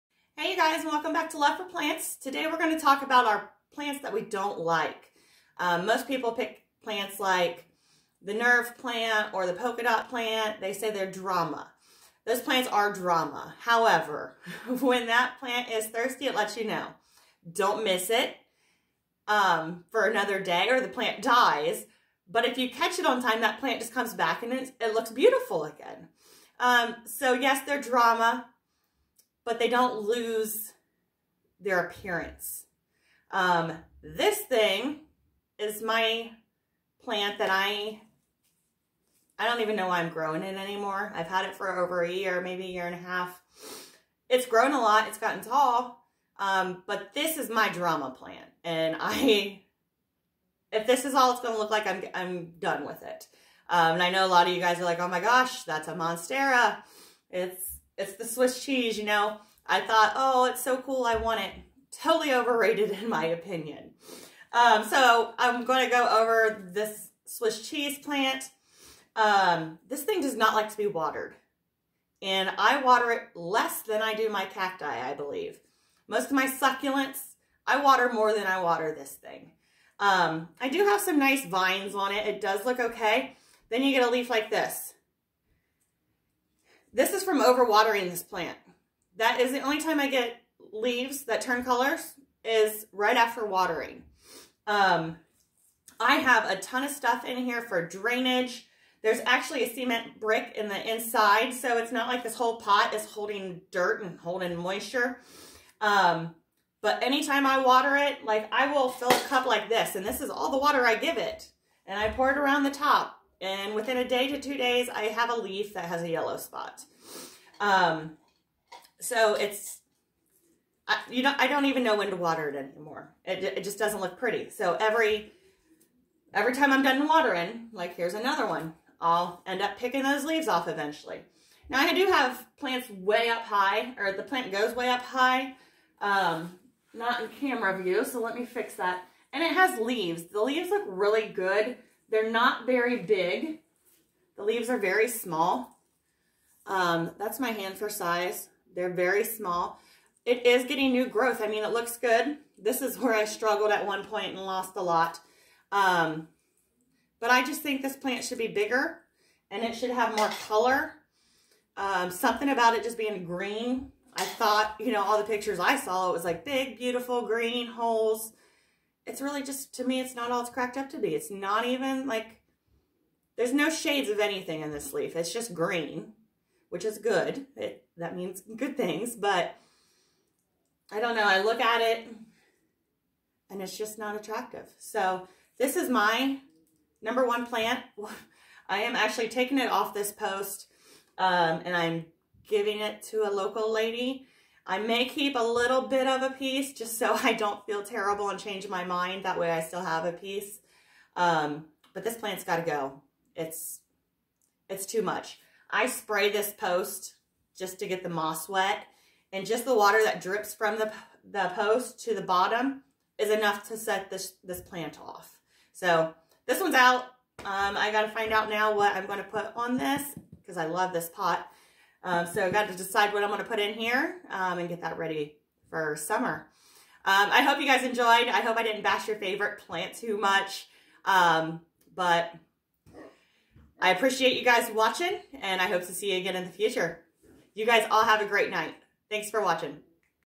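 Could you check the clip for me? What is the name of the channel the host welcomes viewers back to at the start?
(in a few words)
Love for Plants.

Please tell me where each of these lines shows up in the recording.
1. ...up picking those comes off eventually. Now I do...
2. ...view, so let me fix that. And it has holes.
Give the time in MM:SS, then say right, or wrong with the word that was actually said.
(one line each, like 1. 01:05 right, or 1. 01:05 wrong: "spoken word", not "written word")
1. 02:09 wrong: "leaves", not "comes"
2. 02:17 wrong: "leaves", not "holes".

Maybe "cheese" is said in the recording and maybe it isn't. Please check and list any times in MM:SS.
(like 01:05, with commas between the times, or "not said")
00:58, 01:07.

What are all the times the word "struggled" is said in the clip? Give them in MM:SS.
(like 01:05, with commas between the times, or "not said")
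02:33.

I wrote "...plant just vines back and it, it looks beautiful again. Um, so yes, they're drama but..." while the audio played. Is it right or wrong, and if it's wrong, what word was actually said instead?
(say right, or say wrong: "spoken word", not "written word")
wrong: "comes", not "vines".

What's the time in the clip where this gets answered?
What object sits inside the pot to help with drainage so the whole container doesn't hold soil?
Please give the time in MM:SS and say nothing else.
01:39.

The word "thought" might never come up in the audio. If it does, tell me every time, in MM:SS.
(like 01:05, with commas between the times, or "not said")
00:59, 02:44.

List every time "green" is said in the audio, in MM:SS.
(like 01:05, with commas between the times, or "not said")
02:43, 02:47, 02:55.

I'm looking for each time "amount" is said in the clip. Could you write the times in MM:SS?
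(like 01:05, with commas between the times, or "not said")
not said.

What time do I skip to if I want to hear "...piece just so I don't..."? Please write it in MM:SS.
03:16.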